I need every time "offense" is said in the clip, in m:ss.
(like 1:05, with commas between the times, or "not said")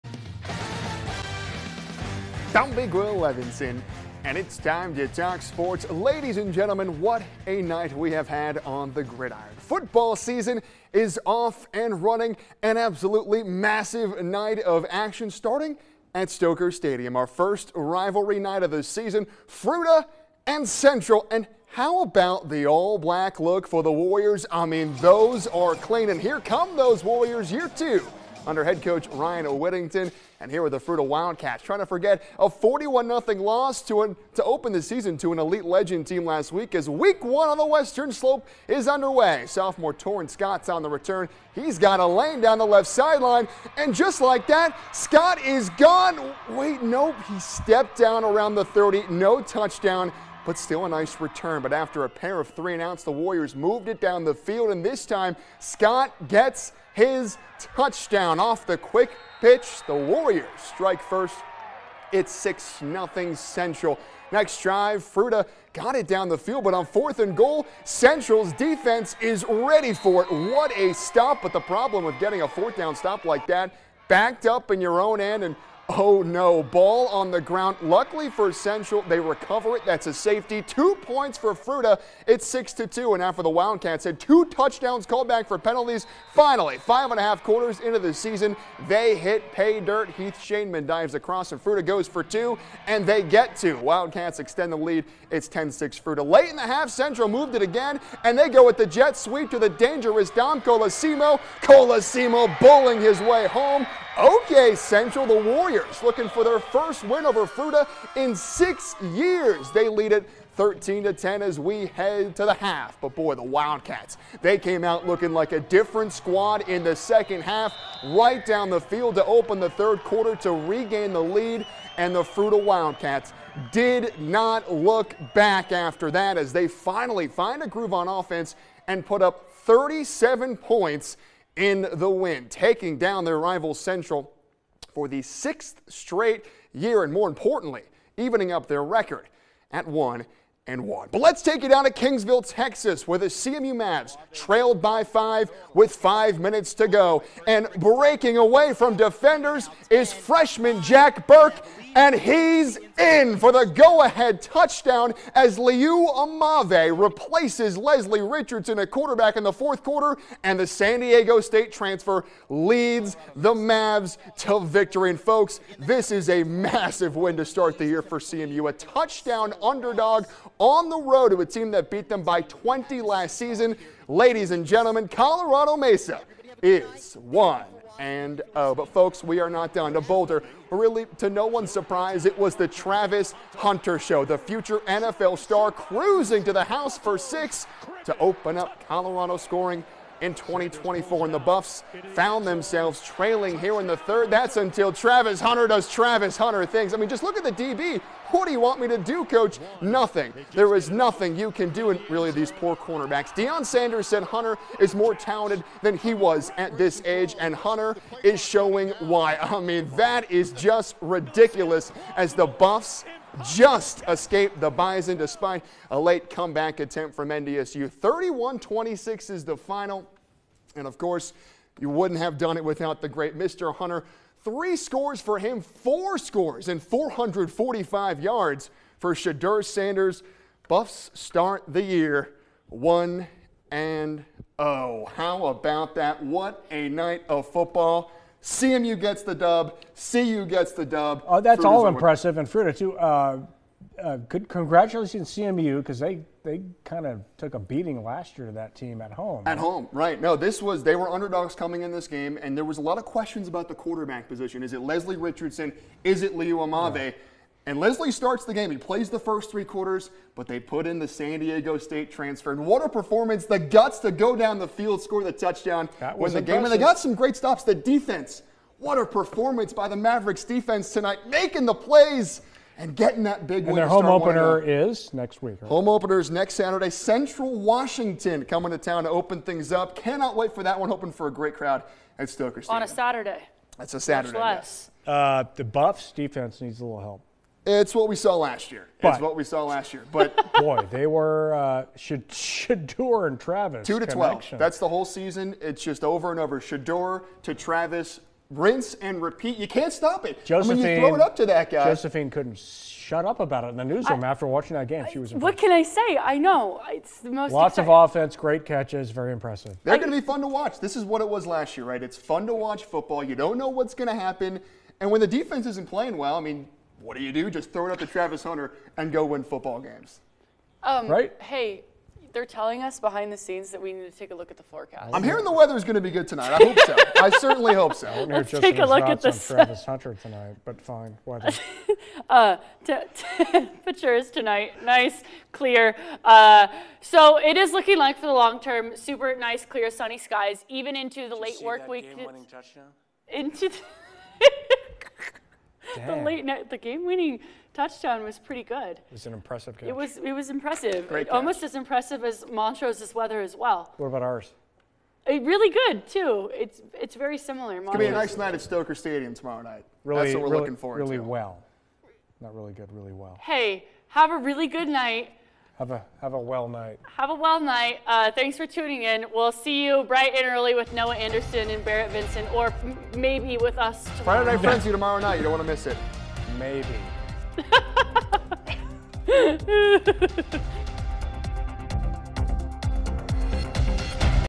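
2:08, 5:08.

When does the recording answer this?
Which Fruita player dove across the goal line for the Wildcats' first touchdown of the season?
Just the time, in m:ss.
1:30.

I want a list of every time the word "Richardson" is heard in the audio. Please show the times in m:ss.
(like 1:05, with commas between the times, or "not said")
2:38, 4:15.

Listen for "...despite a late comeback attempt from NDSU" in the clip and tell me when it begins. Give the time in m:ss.
3:35.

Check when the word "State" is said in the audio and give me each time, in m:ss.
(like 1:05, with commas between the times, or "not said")
2:41, 4:21.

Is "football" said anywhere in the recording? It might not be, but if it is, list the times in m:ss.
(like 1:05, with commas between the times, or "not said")
0:09, 3:57, 5:12, 5:19.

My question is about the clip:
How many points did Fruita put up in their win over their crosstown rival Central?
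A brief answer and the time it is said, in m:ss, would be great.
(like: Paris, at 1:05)
37, at 2:09.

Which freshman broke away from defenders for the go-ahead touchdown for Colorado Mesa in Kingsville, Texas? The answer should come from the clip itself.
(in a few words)
Jack Burke.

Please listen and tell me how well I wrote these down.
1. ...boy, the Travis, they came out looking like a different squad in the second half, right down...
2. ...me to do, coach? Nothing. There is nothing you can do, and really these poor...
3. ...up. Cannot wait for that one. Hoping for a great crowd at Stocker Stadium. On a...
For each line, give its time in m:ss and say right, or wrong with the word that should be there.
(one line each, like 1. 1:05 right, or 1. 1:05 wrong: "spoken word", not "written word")
1. 1:53 wrong: "Wildcats", not "Travis"
2. 3:18 right
3. 4:39 right.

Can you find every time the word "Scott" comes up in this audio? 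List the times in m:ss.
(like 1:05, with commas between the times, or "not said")
0:40, 0:44, 0:55.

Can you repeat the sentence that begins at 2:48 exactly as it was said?
A touchdown underdog on the road to a team that beat them by 20 last season.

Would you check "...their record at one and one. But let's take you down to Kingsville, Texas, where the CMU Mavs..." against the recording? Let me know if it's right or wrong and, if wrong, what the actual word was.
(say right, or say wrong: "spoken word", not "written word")
right.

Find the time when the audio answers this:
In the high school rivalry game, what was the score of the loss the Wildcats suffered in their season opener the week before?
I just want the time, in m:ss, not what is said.
0:32.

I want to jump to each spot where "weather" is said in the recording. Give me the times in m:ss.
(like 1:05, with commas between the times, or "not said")
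5:25, 5:31, 5:53.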